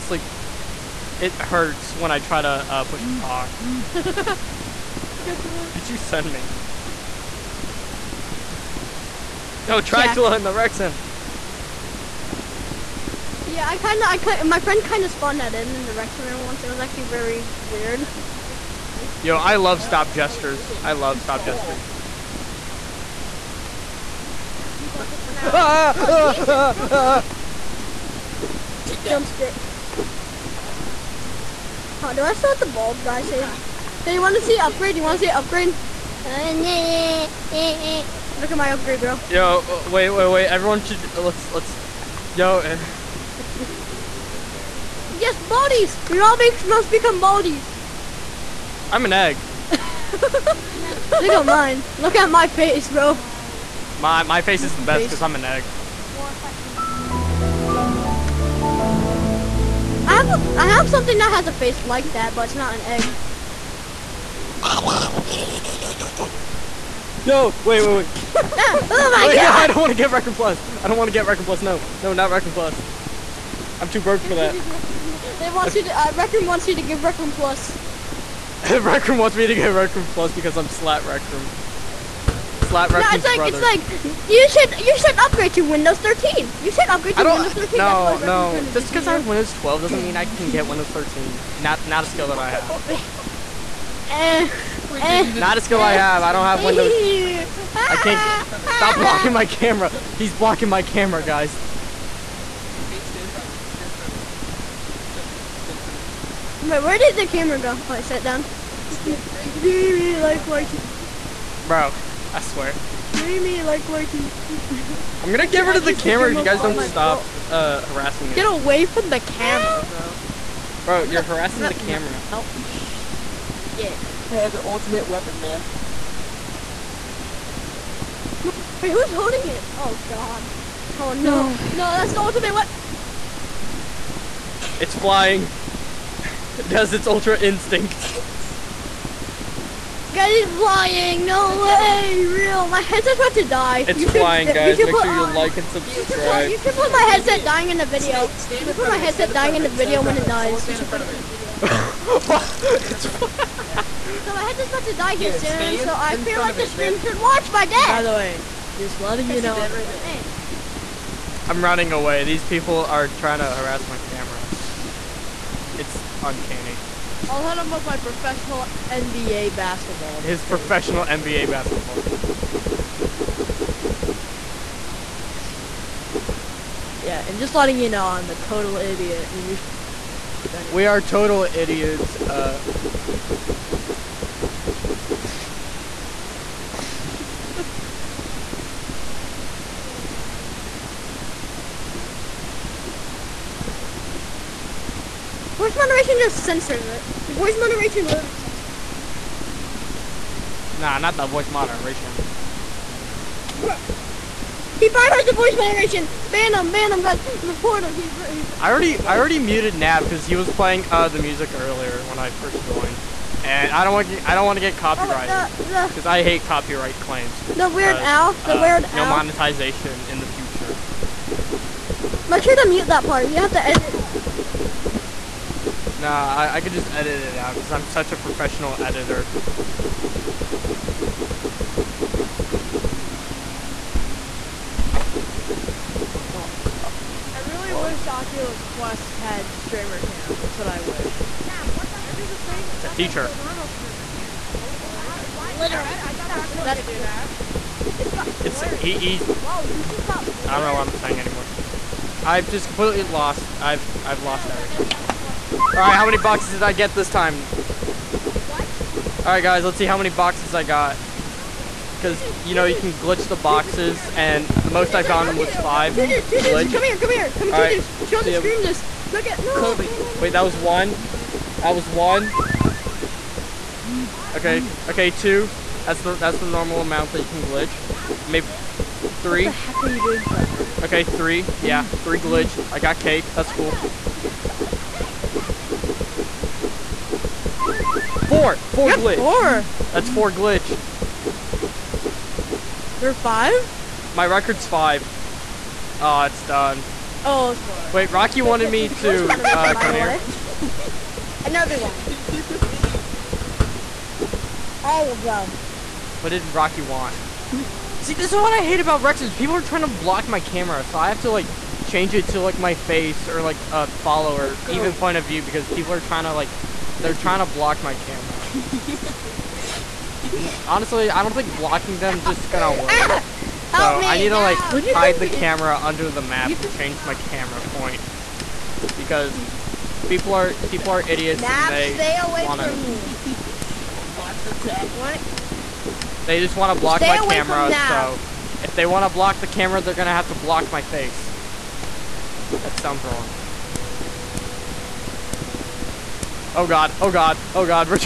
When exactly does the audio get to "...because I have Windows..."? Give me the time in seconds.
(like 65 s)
88 s.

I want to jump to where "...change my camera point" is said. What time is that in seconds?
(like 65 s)
326 s.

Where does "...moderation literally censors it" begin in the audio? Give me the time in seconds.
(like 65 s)
197 s.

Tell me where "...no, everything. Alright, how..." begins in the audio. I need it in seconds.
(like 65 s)
254 s.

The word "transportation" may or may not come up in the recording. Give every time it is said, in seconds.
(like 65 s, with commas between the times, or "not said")
not said.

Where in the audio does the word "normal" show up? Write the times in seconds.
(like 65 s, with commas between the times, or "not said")
243 s, 276 s.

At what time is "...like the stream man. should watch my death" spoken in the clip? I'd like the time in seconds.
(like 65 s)
156 s.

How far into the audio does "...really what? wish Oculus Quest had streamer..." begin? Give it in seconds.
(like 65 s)
237 s.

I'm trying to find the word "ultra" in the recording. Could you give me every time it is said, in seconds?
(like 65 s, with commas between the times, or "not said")
137 s.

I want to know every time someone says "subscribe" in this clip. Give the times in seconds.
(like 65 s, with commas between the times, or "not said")
145 s.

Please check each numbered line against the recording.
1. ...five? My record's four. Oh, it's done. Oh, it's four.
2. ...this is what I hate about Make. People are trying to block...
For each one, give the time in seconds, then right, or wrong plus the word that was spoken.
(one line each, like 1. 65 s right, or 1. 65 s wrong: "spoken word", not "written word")
1. 293 s wrong: "five", not "four"
2. 308 s wrong: "Rexes", not "Make".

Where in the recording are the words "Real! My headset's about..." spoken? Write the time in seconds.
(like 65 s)
142 s.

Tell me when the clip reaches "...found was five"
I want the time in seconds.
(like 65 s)
265 s.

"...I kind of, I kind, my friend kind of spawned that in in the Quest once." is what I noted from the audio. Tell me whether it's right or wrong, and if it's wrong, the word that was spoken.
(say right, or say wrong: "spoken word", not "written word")
wrong: "Rexen", not "Quest".